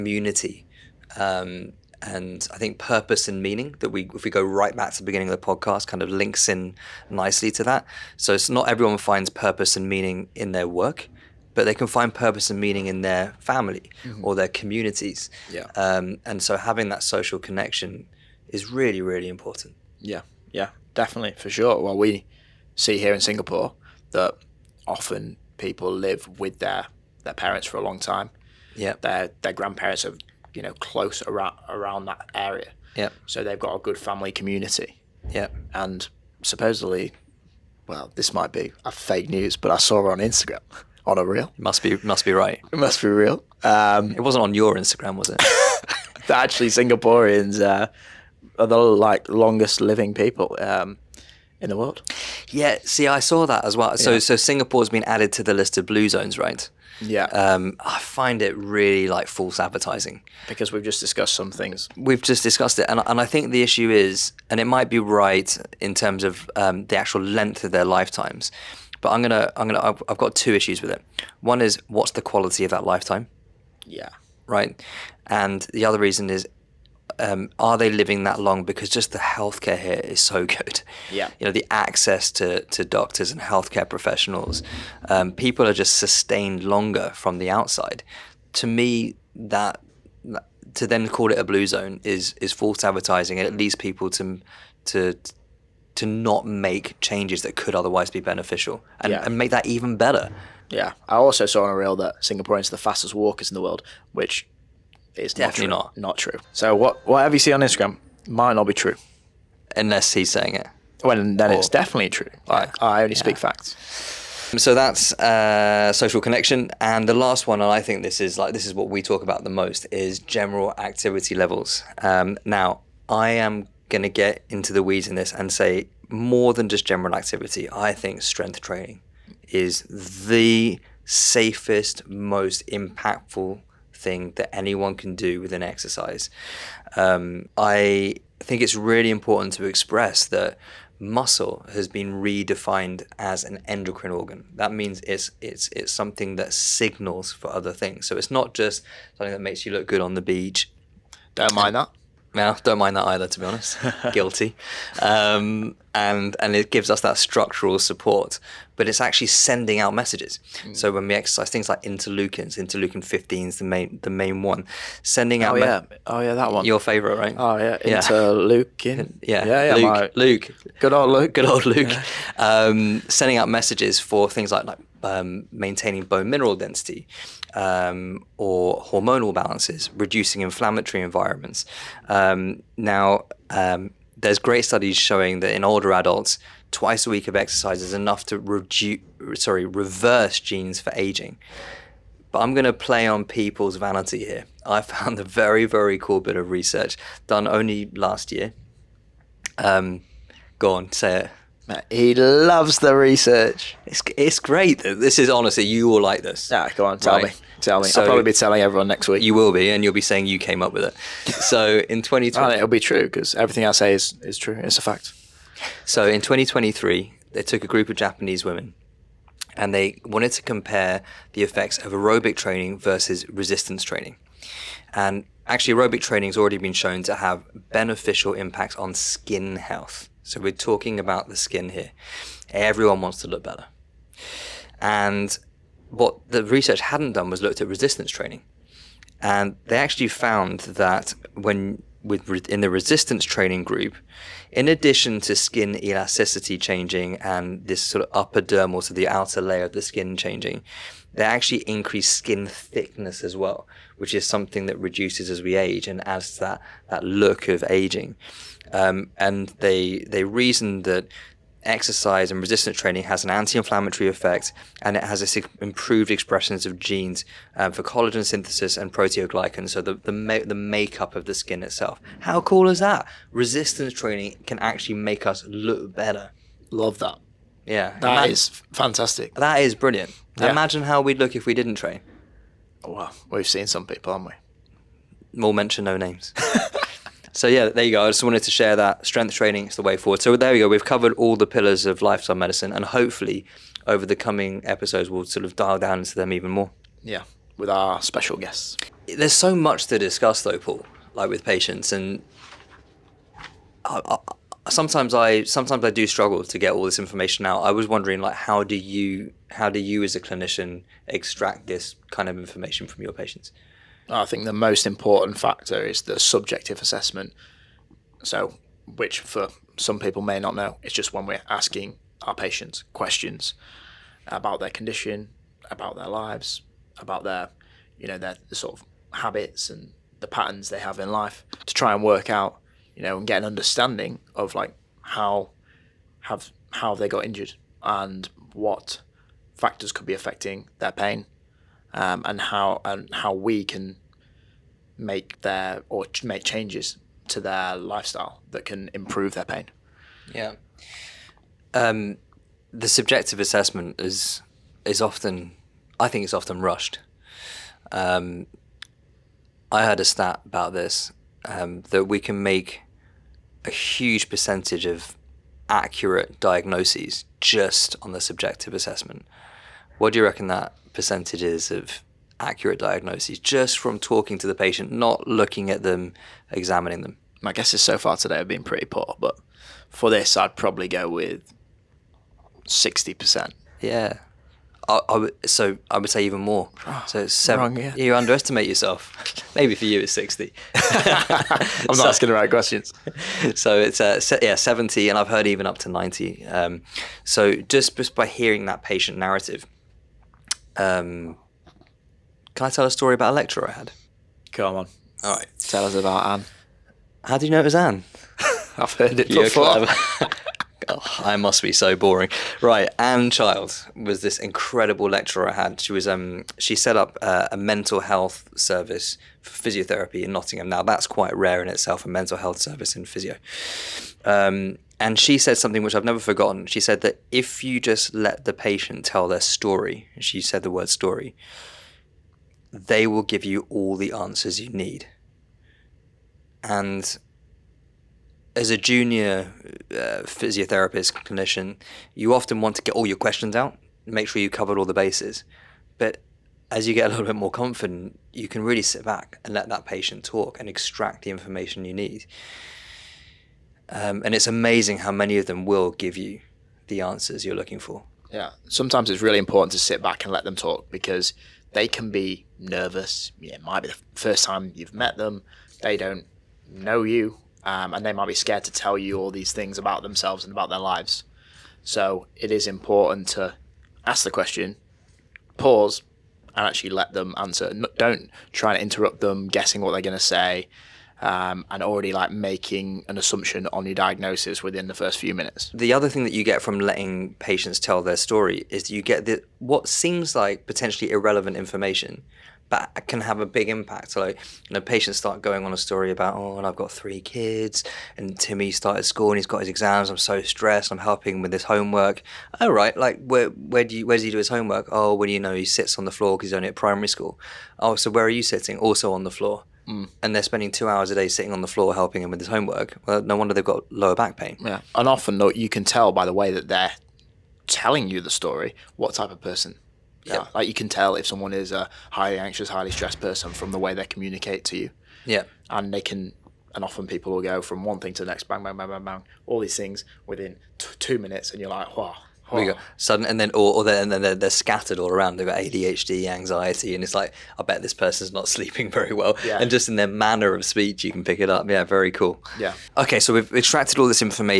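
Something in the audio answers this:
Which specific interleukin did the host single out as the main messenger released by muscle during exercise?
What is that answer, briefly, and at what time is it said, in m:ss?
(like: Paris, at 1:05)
Interleukin 15, at 2:42.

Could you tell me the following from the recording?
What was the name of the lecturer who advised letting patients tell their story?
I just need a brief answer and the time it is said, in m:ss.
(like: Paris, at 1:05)
Anne Child, at 6:52.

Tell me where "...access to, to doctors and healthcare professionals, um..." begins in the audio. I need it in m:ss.
1:21.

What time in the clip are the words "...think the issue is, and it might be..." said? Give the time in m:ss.
1:03.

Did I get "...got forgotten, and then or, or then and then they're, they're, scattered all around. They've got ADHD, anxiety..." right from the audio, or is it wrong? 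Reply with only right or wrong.
wrong.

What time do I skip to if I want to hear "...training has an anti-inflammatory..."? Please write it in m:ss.
4:22.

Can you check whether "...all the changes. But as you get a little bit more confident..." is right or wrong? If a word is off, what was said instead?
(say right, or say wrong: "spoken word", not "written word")
wrong: "bases", not "changes".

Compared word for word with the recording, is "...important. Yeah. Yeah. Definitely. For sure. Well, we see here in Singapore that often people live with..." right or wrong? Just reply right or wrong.
right.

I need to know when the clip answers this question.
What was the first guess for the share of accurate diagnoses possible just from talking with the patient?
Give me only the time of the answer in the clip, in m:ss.
6:22.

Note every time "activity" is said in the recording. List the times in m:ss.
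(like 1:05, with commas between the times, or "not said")
2:00, 2:07.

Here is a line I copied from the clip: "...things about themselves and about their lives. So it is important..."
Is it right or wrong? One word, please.
right.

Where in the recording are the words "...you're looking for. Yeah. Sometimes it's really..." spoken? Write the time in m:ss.
7:37.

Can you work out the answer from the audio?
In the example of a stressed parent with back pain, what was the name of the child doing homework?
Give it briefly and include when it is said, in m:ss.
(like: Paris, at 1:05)
Timmy, at 8:18.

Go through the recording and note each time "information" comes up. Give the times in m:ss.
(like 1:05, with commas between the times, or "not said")
5:07, 5:12, 7:31, 8:11.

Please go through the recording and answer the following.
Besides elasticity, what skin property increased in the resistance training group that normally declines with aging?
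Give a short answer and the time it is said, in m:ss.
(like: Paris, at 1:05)
Skin thickness, at 4:12.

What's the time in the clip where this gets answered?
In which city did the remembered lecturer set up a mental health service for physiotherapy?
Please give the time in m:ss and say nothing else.
7:00.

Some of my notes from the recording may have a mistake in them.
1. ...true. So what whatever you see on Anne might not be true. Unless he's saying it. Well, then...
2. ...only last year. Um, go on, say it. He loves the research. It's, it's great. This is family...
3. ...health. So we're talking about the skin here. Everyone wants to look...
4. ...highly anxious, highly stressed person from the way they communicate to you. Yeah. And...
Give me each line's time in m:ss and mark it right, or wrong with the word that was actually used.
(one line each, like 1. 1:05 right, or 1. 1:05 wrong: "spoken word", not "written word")
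1. 1:46 wrong: "Instagram", not "Anne"
2. 3:17 wrong: "honestly", not "family"
3. 3:49 right
4. 8:42 right.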